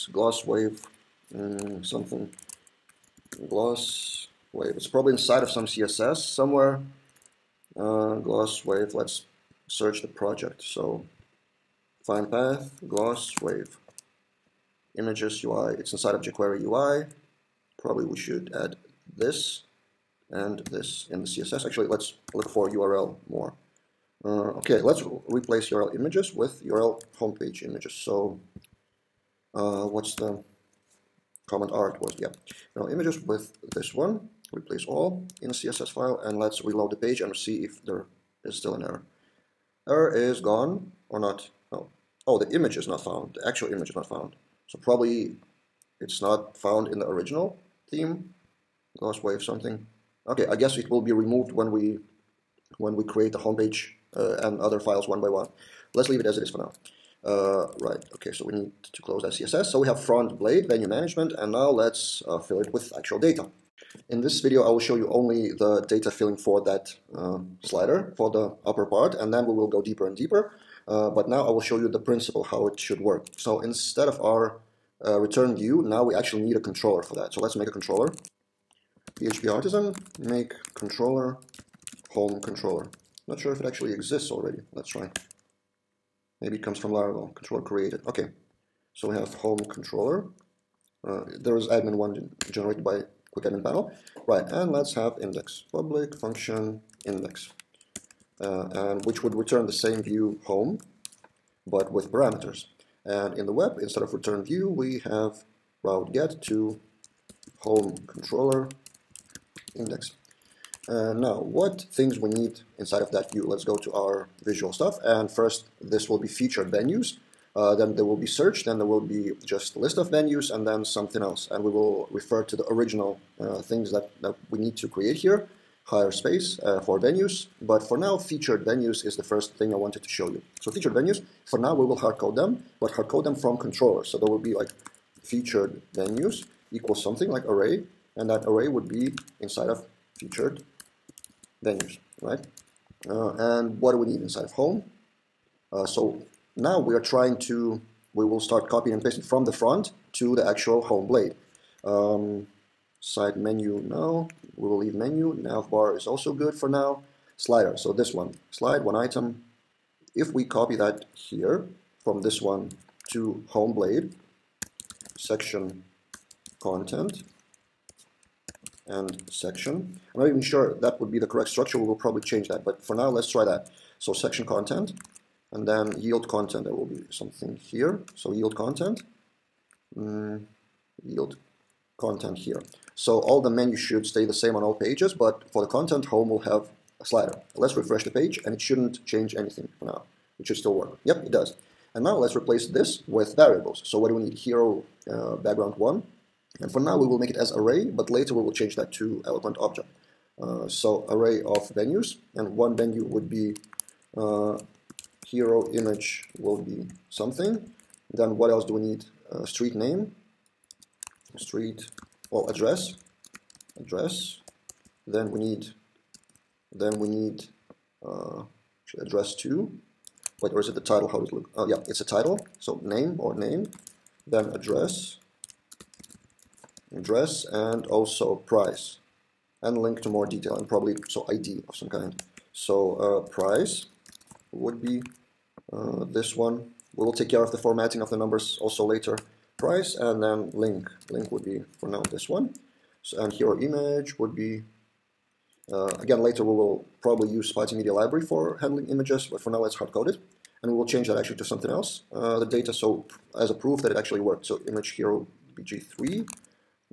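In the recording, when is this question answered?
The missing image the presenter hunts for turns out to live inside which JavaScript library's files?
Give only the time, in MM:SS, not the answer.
00:16.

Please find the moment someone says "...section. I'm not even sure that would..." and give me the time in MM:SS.
02:49.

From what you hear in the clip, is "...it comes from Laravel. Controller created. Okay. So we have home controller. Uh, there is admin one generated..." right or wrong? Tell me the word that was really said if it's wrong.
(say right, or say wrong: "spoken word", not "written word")
right.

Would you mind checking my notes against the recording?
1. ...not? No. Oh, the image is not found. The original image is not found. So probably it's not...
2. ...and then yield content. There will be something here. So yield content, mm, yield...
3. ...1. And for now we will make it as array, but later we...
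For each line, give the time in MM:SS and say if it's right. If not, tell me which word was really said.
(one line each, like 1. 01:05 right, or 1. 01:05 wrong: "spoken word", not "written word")
1. 00:41 wrong: "actual", not "original"
2. 02:55 right
3. 03:15 right.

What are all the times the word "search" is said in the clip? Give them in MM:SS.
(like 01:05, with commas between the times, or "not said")
00:09, 01:58.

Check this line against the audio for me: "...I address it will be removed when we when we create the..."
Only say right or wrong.
wrong.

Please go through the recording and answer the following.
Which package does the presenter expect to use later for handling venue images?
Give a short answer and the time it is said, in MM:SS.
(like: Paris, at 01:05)
Spatie Media Library, at 04:07.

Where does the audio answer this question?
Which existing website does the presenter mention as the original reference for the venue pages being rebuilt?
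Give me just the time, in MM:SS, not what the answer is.
02:05.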